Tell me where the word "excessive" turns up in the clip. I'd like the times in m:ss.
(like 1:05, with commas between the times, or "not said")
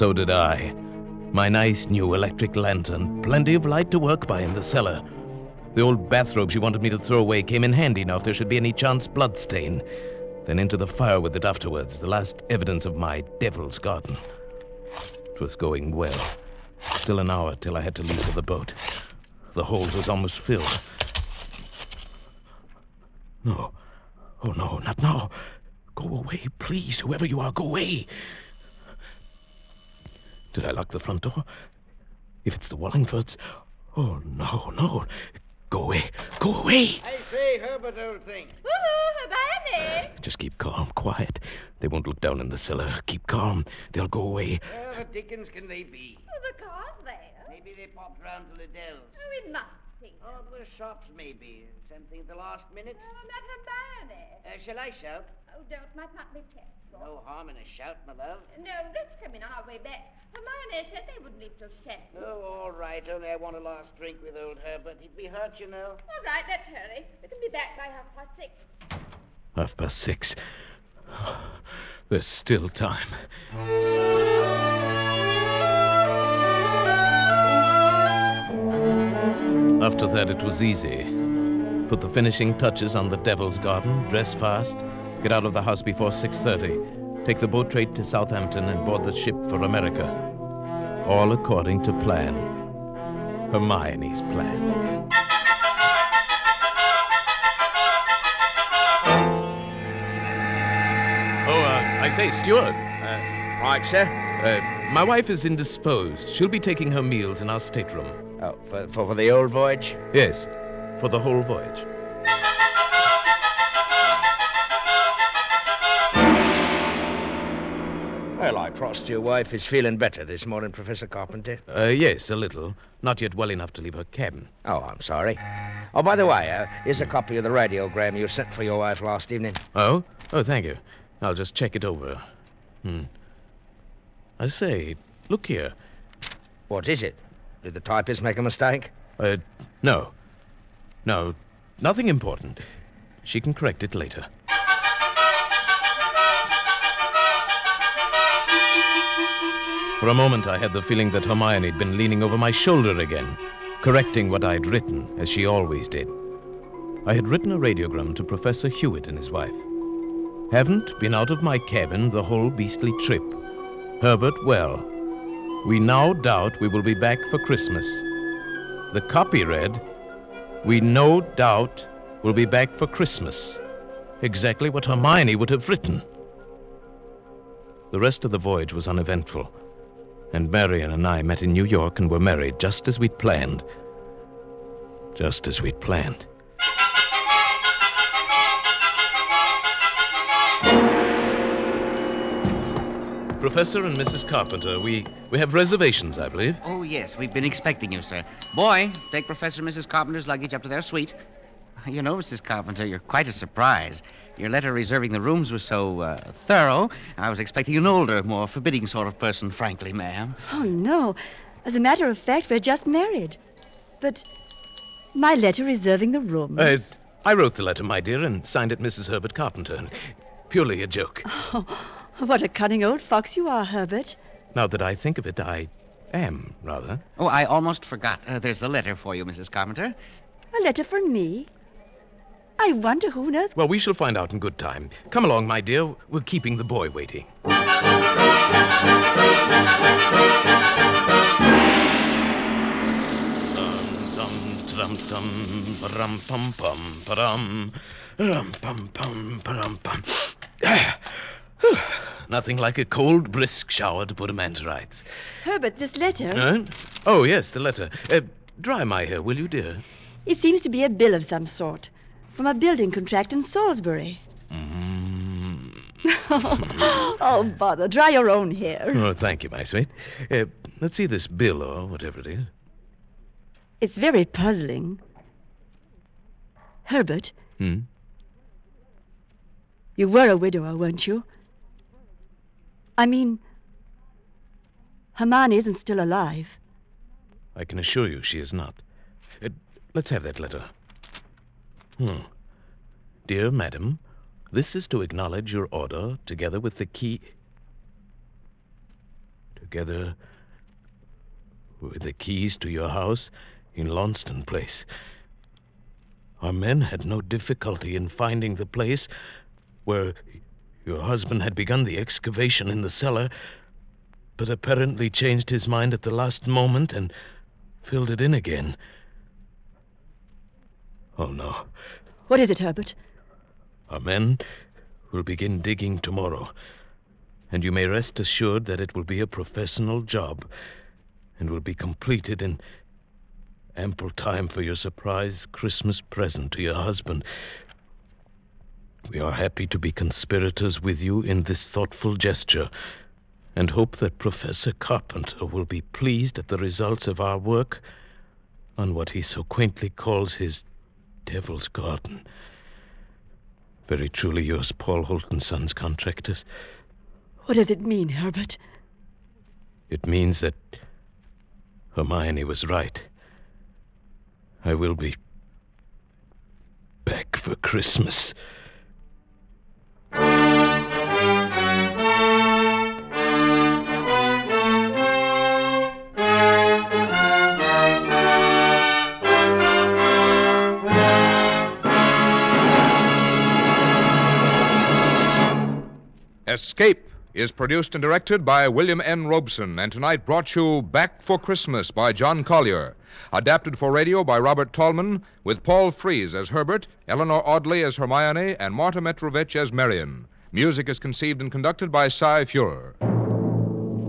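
not said.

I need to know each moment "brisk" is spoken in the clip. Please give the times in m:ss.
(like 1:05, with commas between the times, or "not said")
4:13.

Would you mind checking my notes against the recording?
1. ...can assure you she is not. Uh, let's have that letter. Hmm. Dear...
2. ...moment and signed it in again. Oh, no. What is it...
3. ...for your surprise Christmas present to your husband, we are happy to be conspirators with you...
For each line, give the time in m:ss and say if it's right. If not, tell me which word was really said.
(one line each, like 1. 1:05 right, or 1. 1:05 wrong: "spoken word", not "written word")
1. 4:47 right
2. 5:16 wrong: "filled", not "signed"
3. 5:34 right.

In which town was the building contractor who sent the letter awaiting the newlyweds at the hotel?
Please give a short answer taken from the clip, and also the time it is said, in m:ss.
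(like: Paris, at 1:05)
Salisbury, at 4:23.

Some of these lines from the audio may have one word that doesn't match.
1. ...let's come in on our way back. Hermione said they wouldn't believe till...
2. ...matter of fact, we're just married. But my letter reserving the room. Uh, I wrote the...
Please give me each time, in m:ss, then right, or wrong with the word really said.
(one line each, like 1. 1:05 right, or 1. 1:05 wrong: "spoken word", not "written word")
1. 0:58 wrong: "leave", not "believe"
2. 3:31 right.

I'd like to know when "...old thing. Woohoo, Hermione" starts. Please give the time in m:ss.
0:37.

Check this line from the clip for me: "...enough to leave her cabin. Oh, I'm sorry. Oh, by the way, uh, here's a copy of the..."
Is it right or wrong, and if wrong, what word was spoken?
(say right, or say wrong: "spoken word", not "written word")
right.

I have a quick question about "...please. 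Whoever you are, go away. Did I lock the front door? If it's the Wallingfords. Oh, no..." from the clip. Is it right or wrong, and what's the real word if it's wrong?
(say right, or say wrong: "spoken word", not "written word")
right.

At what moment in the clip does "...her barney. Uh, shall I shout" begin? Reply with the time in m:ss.
0:53.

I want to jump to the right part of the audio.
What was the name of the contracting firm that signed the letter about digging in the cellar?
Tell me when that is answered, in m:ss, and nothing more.
5:54.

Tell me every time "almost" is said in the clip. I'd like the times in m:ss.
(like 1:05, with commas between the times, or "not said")
0:20, 3:47.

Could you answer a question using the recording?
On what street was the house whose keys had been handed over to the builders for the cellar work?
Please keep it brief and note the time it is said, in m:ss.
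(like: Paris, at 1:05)
Launceston Place, at 5:03.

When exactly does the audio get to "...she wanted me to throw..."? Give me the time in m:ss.
0:06.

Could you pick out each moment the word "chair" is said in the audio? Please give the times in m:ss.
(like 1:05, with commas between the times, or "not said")
not said.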